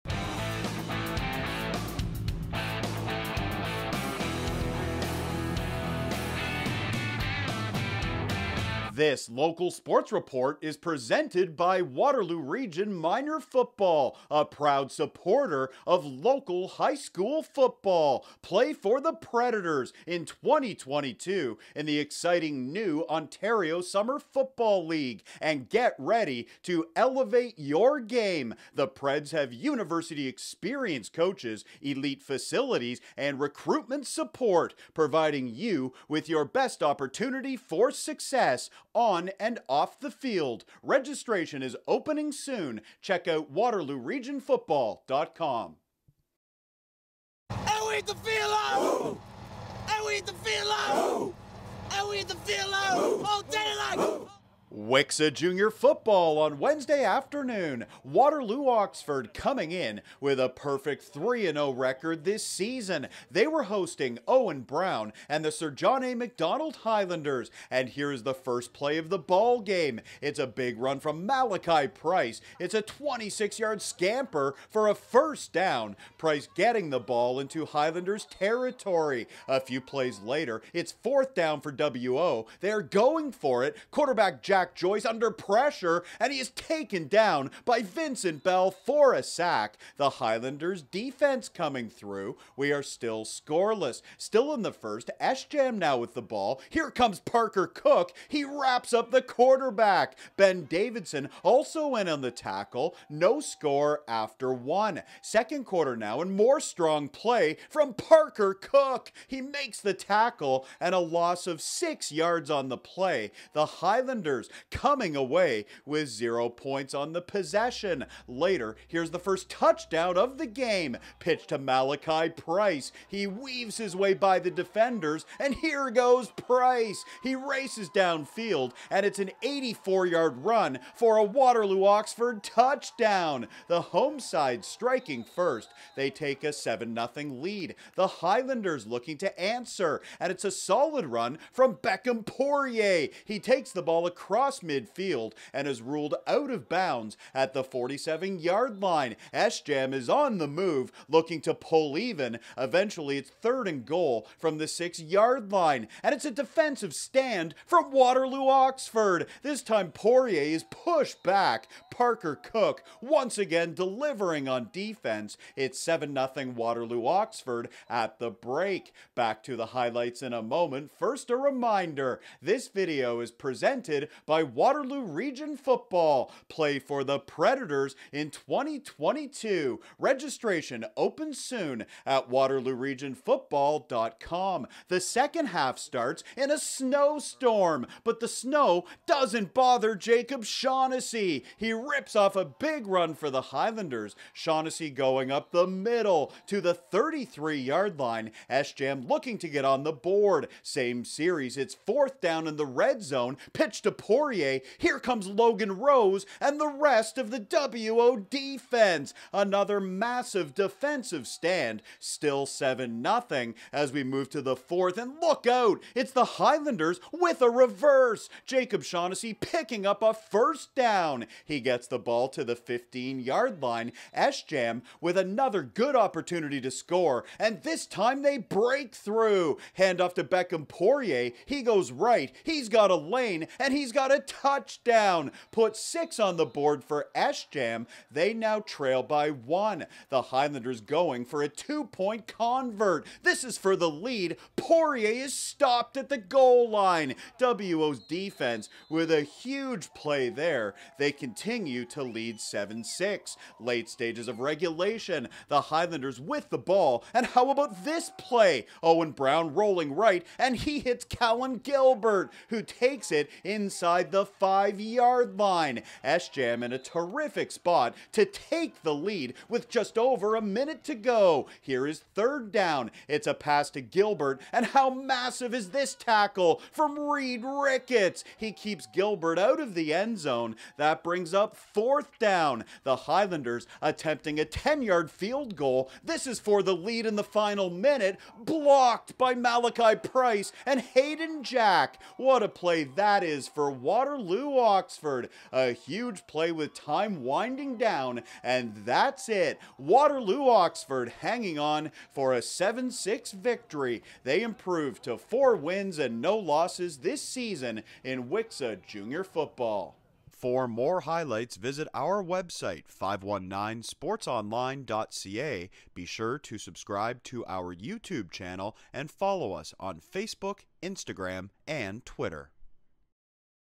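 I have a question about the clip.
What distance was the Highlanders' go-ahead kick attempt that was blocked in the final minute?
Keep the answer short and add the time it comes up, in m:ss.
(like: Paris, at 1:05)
10 yards, at 4:44.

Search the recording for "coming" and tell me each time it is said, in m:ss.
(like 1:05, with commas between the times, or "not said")
0:59, 1:31, 1:54.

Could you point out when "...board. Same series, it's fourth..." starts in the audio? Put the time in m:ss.
3:19.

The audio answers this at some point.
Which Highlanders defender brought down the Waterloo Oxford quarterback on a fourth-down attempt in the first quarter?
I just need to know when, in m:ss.
1:27.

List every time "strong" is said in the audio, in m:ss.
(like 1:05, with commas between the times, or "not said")
1:46.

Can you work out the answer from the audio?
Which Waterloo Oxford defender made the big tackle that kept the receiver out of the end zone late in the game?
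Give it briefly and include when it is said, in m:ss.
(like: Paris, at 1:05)
Reed Ricketts, at 4:36.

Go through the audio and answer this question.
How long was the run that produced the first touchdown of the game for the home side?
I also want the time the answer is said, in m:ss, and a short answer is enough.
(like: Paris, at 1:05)
84 yards, at 2:09.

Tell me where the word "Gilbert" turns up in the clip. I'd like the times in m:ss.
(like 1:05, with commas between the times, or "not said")
4:21, 4:33, 4:38.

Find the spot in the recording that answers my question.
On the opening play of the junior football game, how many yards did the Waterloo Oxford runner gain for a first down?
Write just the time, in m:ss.
1:12.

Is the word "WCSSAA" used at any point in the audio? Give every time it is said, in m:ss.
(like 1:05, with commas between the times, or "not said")
0:54, 5:08.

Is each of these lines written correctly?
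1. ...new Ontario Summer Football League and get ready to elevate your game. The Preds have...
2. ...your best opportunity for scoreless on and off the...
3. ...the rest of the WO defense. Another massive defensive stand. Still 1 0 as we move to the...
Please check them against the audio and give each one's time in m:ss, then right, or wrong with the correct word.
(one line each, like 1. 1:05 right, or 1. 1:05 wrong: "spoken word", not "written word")
1. 0:22 right
2. 0:36 wrong: "success", not "scoreless"
3. 3:26 wrong: "7", not "1".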